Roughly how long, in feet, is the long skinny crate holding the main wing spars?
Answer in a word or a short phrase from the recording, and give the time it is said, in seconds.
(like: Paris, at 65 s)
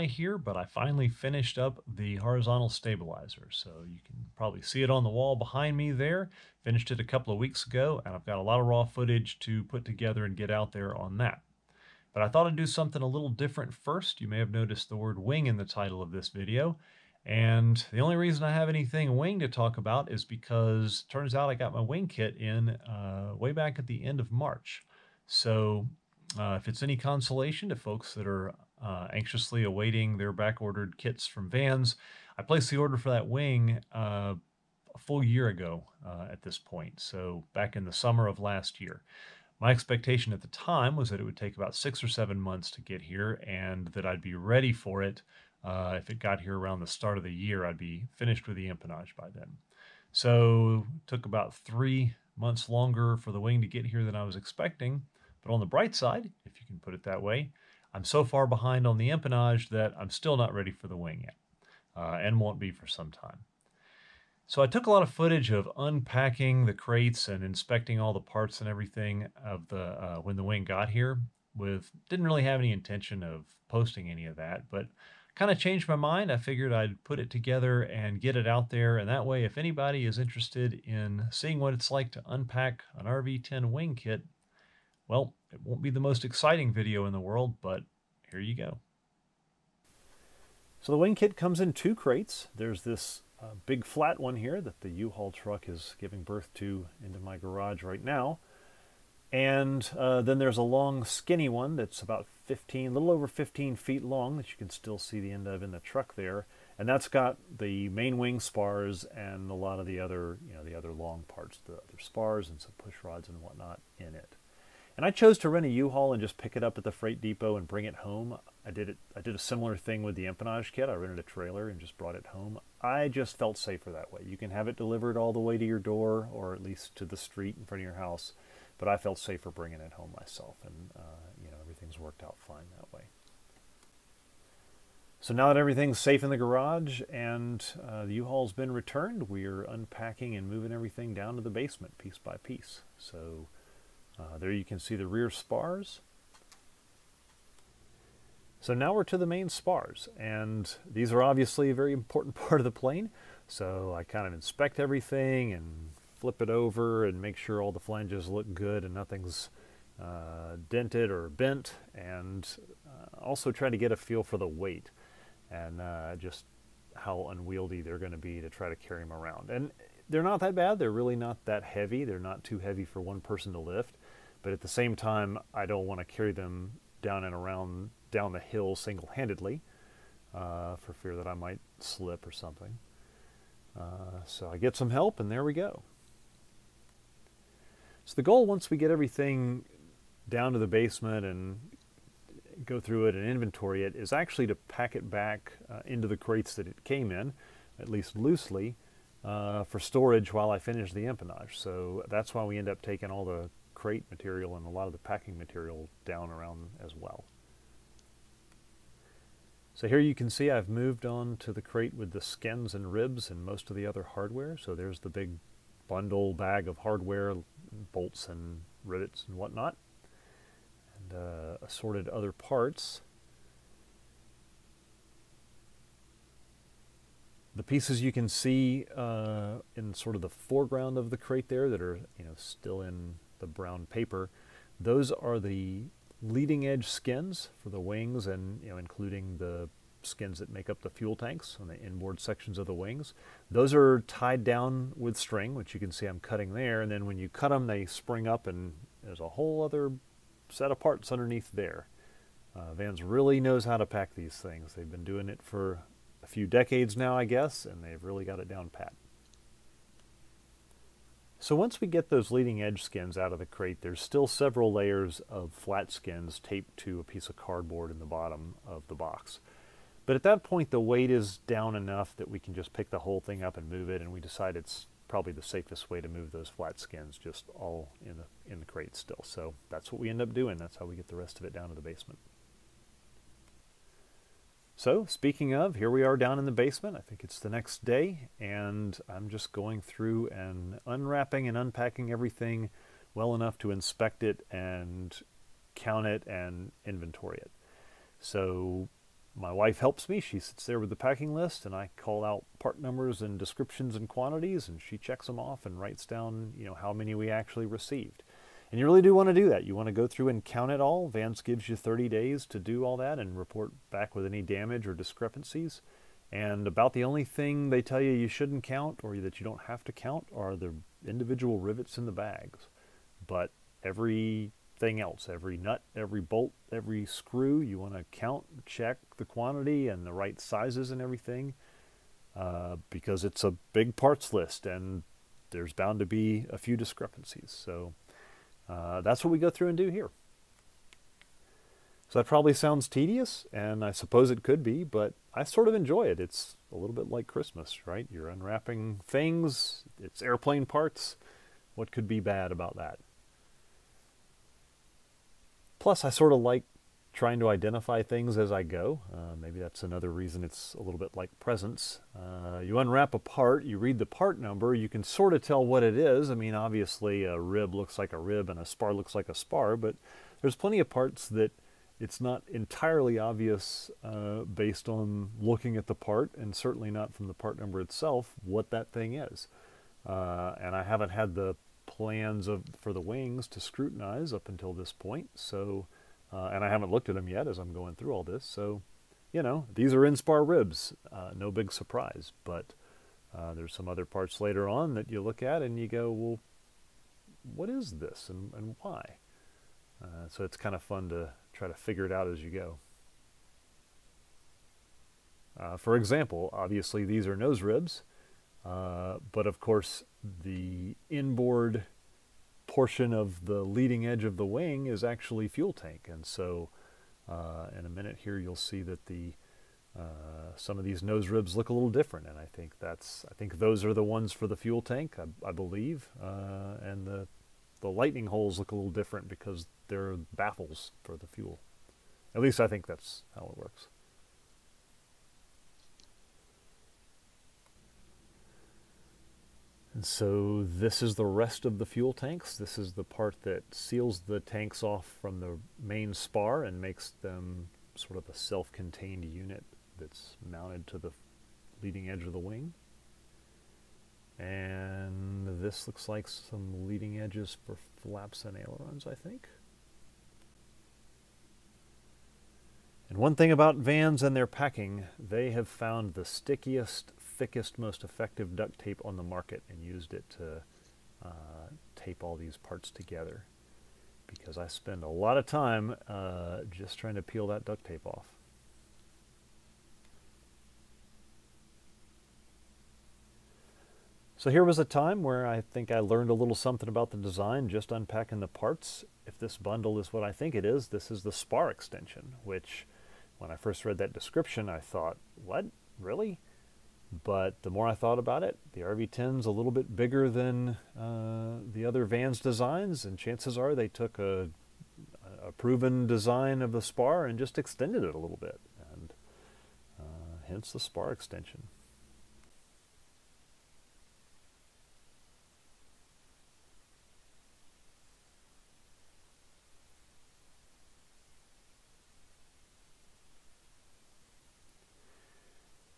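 15 feet, at 102 s.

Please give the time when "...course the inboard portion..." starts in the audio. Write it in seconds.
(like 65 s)
409 s.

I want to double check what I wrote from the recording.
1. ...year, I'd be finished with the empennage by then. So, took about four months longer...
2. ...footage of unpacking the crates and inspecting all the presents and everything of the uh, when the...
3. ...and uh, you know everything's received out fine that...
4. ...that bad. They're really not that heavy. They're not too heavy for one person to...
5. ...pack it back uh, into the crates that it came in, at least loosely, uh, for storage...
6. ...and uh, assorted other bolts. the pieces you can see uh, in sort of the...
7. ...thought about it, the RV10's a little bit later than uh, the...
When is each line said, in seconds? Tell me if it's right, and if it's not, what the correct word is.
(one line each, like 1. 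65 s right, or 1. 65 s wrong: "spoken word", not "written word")
1. 47 s wrong: "three", not "four"
2. 65 s wrong: "parts", not "presents"
3. 130 s wrong: "worked", not "received"
4. 170 s right
5. 194 s right
6. 221 s wrong: "parts", not "bolts"
7. 497 s wrong: "bigger", not "later".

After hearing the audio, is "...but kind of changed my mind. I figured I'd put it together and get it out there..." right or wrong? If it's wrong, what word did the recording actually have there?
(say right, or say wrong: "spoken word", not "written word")
right.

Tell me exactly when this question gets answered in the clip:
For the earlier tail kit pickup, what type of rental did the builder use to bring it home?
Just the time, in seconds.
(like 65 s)
120 s.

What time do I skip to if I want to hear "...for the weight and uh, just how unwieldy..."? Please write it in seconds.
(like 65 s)
164 s.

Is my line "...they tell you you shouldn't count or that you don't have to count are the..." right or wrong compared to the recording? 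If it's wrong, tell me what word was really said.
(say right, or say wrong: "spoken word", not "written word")
right.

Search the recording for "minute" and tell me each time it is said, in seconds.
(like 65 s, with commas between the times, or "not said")
417 s.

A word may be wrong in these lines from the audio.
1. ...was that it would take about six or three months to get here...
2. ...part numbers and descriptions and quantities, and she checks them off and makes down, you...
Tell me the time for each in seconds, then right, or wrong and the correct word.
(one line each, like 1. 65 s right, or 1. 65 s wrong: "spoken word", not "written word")
1. 40 s wrong: "seven", not "three"
2. 302 s wrong: "writes", not "makes".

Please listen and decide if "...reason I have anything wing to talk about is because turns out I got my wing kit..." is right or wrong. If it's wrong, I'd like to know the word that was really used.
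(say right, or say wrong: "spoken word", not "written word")
right.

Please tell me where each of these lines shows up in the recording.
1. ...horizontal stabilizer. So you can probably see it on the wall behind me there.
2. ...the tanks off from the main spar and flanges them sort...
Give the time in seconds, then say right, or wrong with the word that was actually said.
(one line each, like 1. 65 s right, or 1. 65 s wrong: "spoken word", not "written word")
1. 2 s right
2. 444 s wrong: "makes", not "flanges".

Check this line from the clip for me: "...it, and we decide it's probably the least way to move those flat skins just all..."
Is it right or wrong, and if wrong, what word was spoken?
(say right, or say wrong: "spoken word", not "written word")
wrong: "safest", not "least".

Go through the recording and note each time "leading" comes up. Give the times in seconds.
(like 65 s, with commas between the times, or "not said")
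236 s, 262 s, 413 s, 451 s, 456 s.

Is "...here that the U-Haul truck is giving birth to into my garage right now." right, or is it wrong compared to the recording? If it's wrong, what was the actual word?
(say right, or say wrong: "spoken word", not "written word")
right.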